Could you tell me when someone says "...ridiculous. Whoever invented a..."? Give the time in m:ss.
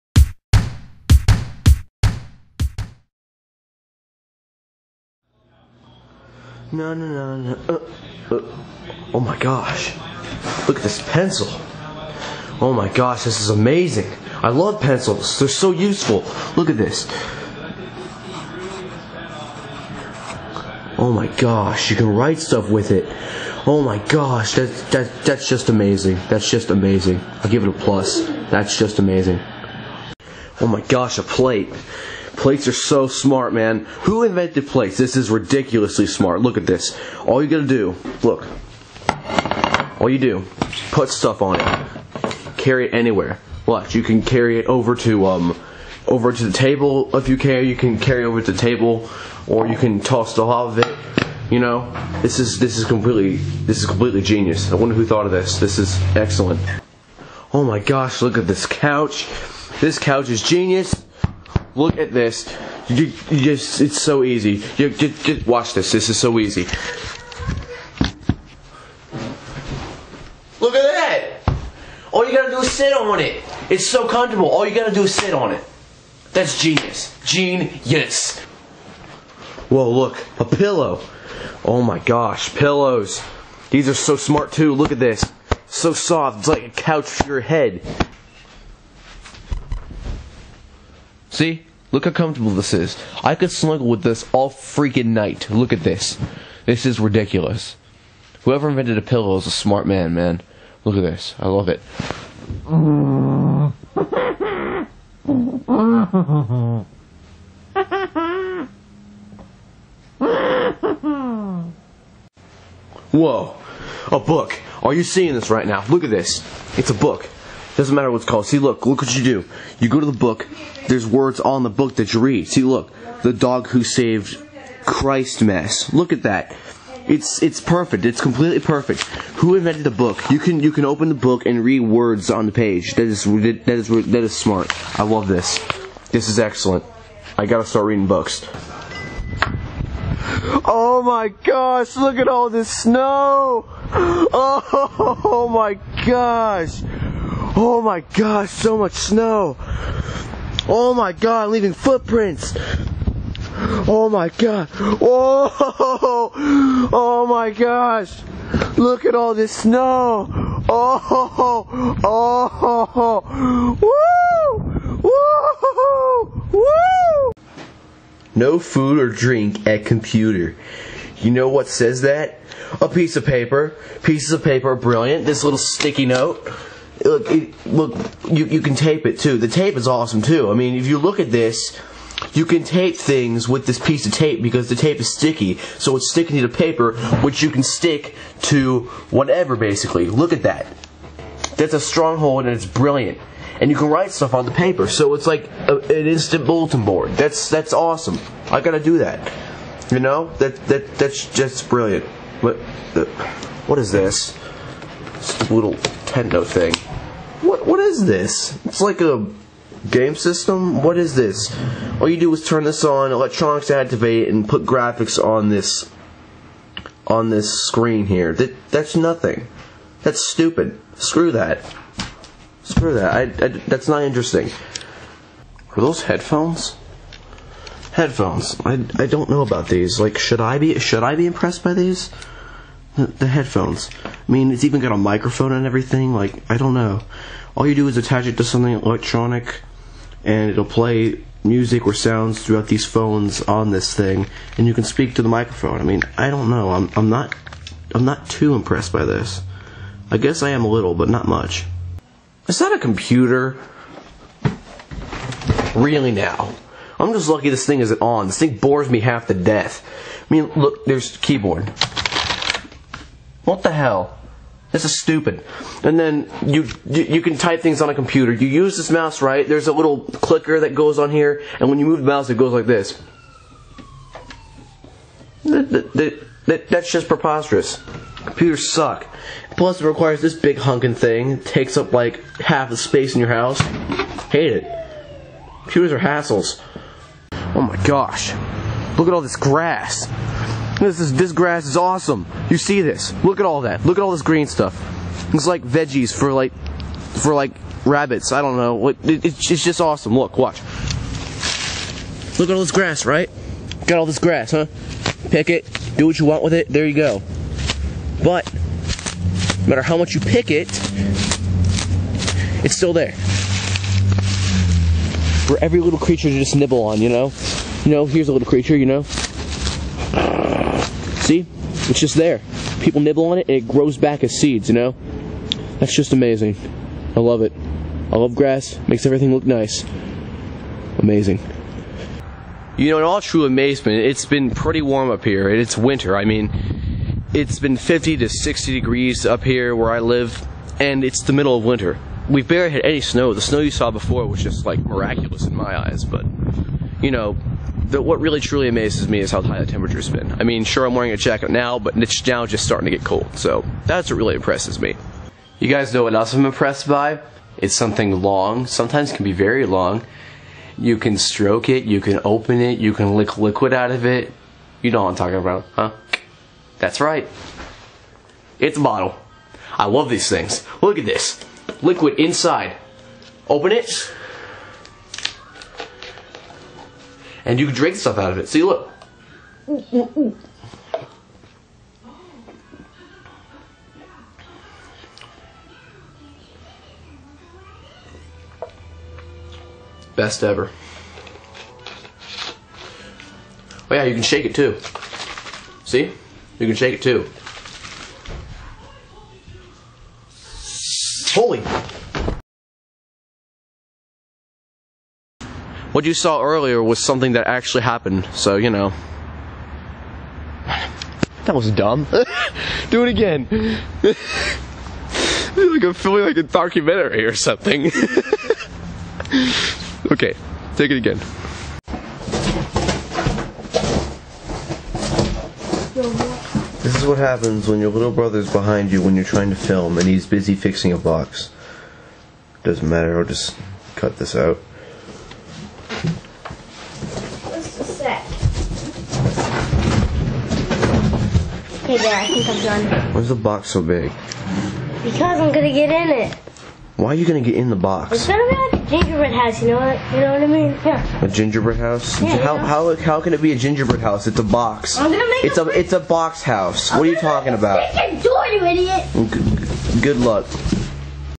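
1:36.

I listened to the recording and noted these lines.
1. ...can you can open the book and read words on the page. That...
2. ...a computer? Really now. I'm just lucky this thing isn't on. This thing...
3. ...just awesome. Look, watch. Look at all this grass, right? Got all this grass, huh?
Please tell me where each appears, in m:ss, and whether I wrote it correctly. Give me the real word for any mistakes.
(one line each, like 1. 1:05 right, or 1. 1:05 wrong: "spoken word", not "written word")
1. 2:10 right
2. 4:12 right
3. 4:59 right.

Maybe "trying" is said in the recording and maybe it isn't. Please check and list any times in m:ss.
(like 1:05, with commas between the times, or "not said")
7:09.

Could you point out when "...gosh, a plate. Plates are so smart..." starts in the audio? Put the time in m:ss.
0:30.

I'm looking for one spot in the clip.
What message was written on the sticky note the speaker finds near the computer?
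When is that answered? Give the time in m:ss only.
2:48.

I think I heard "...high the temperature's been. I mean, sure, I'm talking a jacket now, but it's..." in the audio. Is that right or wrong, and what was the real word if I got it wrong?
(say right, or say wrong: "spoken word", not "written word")
wrong: "wearing", not "talking".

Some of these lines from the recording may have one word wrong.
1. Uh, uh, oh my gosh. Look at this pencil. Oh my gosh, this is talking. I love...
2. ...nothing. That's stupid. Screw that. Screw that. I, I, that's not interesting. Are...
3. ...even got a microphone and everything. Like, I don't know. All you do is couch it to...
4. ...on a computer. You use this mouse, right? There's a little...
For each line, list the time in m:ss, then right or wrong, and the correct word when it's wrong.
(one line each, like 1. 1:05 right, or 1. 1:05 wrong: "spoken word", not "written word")
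1. 0:07 wrong: "amazing", not "talking"
2. 3:38 right
3. 3:54 wrong: "attach", not "couch"
4. 4:27 right.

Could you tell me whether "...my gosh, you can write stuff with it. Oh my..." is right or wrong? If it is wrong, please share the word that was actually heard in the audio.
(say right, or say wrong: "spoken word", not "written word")
right.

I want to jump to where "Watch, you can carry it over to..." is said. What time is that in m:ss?
0:43.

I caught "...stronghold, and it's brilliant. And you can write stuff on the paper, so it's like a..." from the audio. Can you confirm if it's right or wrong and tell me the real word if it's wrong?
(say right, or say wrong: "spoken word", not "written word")
right.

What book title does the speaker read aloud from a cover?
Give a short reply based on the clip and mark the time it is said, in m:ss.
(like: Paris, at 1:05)
The Dog Who Saved Christmas, at 2:03.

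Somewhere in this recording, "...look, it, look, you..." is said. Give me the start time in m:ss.
2:57.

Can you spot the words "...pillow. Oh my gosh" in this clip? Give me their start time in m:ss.
1:20.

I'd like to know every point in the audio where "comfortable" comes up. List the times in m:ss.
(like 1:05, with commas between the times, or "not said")
1:14, 1:32.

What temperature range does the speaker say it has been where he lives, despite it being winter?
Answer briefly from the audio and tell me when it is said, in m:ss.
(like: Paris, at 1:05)
50 to 60 degrees, at 5:37.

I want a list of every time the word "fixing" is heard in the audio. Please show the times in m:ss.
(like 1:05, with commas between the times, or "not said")
7:10.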